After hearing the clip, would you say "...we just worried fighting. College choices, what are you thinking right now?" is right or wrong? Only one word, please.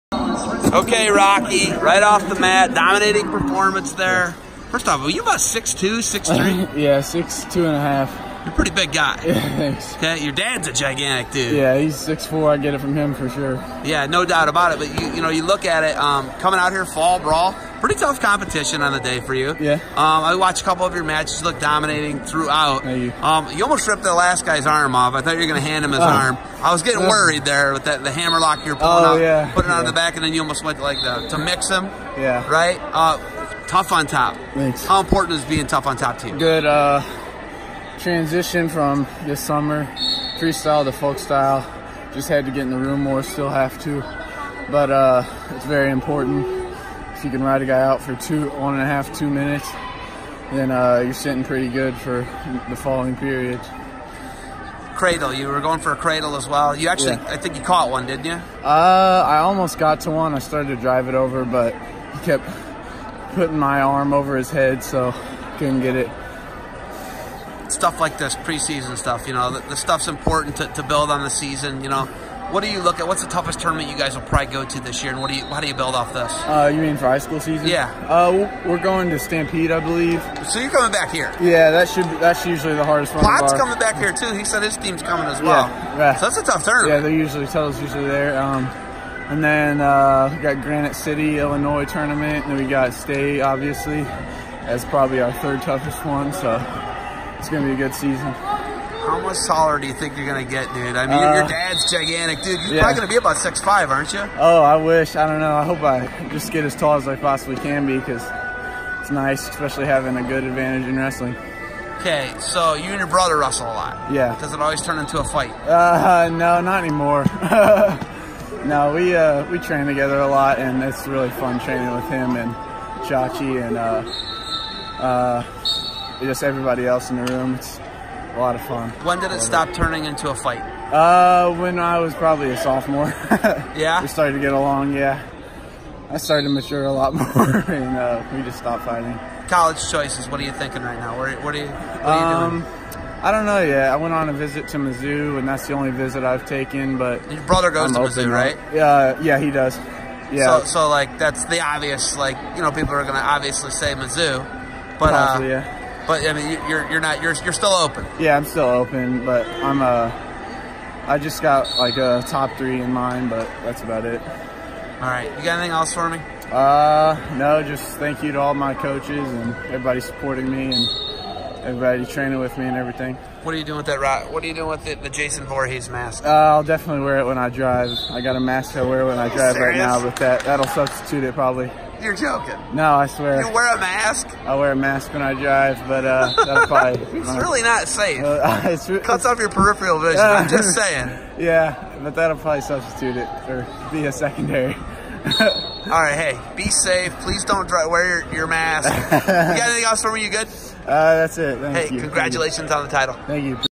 wrong.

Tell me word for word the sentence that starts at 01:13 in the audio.
What's the toughest tournament you guys will probably go to this year, and what do you?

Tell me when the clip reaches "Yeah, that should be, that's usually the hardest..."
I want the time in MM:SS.
01:21.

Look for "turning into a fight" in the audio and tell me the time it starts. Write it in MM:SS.
02:09.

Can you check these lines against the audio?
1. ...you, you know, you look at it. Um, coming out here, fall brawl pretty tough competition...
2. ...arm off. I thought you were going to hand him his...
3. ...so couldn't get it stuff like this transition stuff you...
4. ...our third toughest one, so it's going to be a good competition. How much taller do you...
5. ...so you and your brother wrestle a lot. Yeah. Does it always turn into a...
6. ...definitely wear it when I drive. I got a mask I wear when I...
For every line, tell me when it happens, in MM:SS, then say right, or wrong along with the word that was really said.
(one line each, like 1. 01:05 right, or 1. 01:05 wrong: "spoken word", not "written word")
1. 00:15 right
2. 00:24 right
3. 01:04 wrong: "preseason", not "transition"
4. 01:35 wrong: "season", not "competition"
5. 01:52 right
6. 02:56 right.